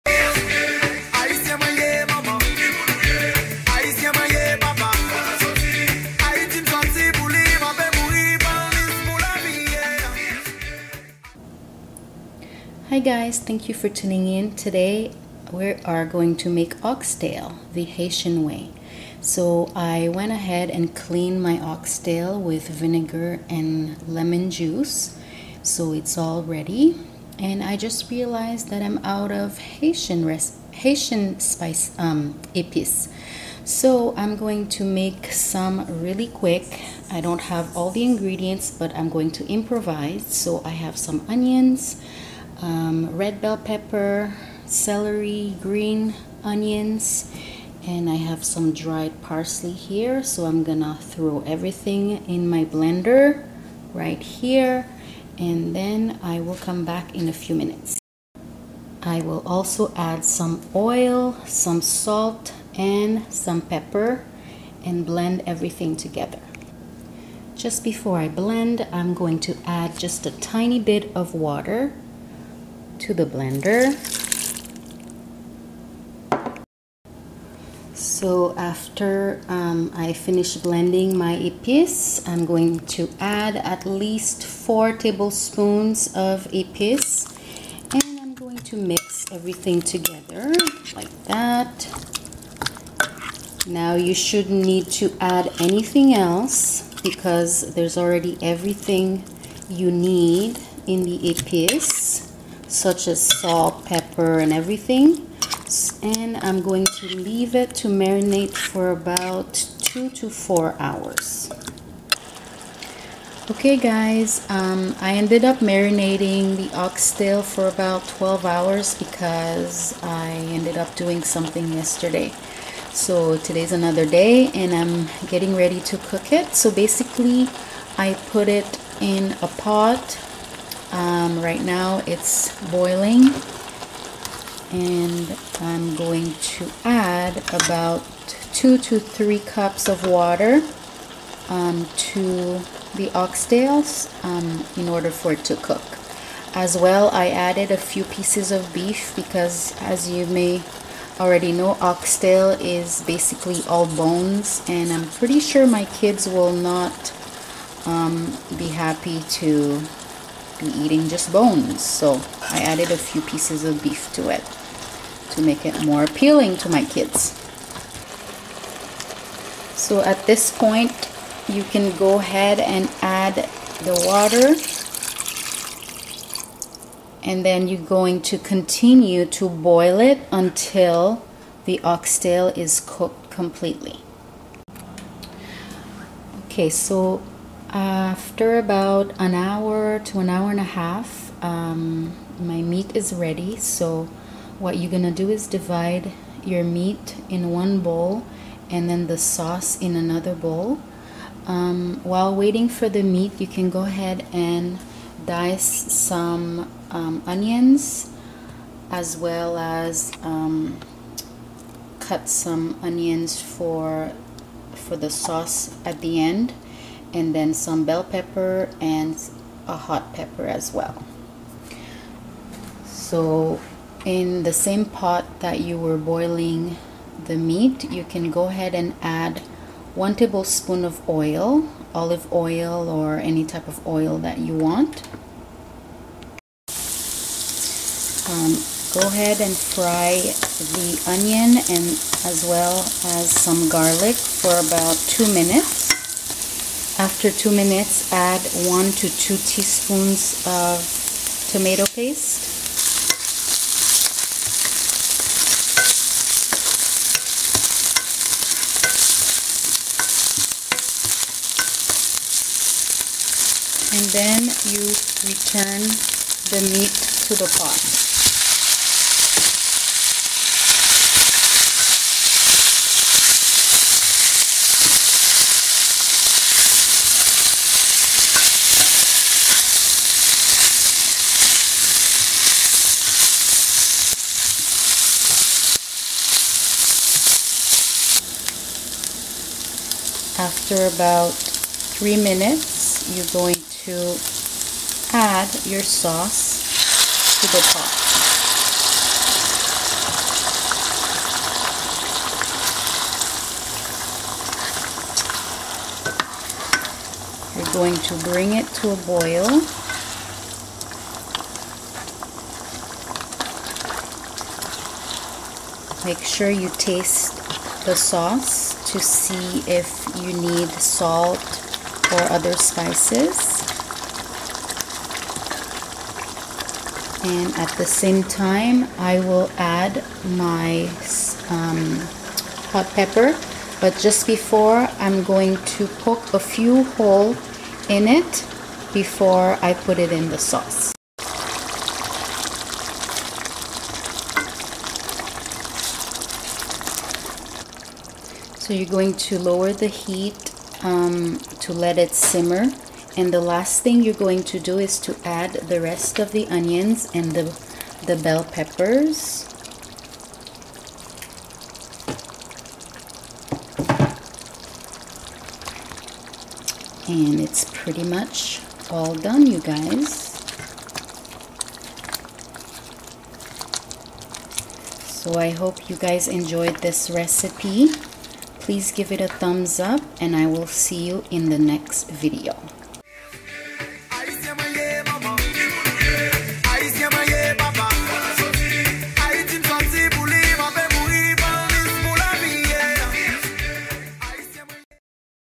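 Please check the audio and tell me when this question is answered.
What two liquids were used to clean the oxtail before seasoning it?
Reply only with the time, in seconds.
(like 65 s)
22 s.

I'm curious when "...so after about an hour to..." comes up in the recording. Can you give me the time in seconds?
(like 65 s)
186 s.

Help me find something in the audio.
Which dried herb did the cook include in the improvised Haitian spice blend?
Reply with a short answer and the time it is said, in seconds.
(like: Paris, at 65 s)
parsley, at 48 s.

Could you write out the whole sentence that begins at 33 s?
So I'm going to make some really quick.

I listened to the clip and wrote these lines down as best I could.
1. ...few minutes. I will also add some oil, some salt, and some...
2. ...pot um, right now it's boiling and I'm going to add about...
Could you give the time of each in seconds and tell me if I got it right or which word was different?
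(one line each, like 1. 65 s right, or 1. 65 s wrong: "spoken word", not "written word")
1. 57 s right
2. 129 s right.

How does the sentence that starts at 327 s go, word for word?
And at the same time, I will add my um, hot pepper.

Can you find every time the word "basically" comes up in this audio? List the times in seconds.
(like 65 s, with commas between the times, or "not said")
126 s, 153 s.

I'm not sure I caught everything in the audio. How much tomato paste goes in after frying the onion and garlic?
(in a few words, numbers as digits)
1 to 2 teaspoons.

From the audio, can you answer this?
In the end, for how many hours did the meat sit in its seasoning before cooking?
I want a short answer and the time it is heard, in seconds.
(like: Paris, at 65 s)
12 hours, at 118 s.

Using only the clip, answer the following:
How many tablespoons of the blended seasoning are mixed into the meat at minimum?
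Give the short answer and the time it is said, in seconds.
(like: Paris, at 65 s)
4 tablespoons, at 84 s.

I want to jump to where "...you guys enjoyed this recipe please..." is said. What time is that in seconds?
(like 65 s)
375 s.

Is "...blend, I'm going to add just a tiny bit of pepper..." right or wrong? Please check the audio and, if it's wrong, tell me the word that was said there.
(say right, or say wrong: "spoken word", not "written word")
wrong: "water", not "pepper".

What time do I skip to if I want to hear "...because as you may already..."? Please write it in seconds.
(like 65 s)
149 s.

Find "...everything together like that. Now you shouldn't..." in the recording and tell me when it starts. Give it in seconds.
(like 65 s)
89 s.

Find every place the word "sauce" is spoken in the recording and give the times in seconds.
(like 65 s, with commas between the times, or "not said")
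199 s, 215 s, 295 s, 317 s, 340 s.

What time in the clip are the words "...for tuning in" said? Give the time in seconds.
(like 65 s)
13 s.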